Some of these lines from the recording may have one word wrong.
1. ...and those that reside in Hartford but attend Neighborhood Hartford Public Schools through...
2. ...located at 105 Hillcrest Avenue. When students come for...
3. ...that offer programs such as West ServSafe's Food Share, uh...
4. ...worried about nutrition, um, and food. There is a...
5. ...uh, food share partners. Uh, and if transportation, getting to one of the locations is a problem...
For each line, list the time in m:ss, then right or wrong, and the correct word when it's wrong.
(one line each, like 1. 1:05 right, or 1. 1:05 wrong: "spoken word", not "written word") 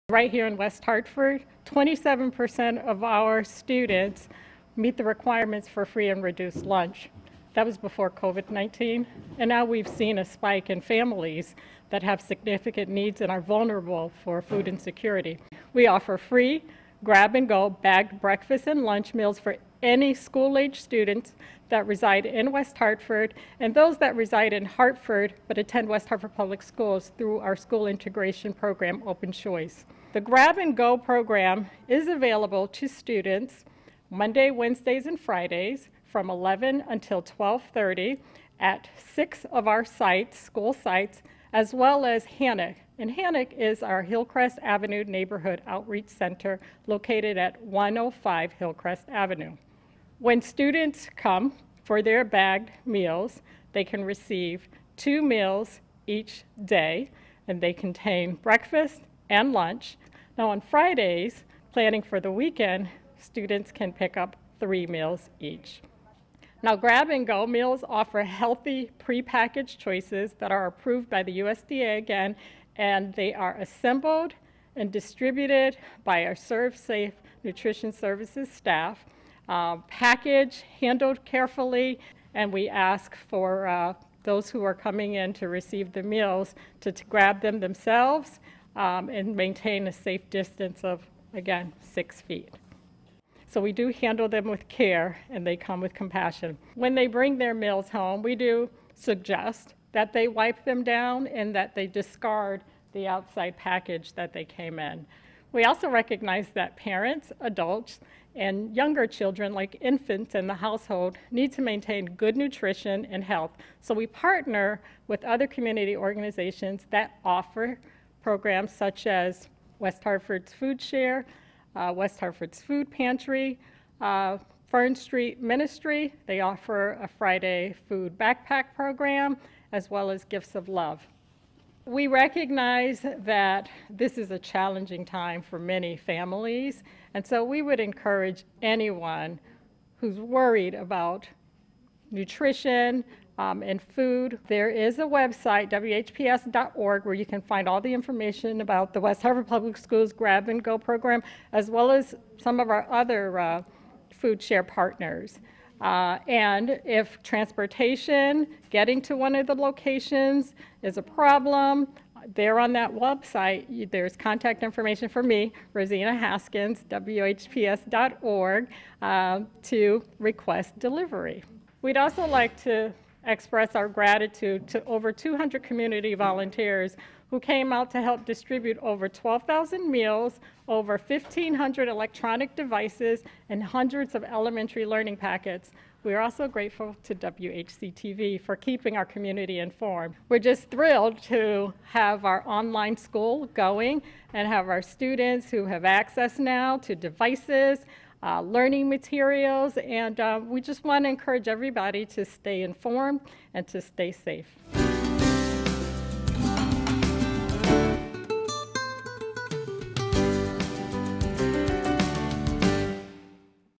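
1. 0:23 wrong: "West", not "Neighborhood"
2. 0:46 right
3. 1:56 wrong: "Hartford", not "ServSafe"
4. 2:20 right
5. 2:33 right.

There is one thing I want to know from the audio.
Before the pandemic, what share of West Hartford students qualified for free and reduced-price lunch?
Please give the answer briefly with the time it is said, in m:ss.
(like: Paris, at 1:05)
27%, at 0:01.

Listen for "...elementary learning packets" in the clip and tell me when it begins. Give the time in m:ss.
3:04.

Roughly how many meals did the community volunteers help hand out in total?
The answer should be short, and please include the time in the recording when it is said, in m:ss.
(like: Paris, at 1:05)
over 12,000, at 2:58.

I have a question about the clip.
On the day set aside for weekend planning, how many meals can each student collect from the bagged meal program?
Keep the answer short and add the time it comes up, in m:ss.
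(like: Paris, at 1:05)
3, at 1:04.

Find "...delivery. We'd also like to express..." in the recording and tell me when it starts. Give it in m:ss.
2:50.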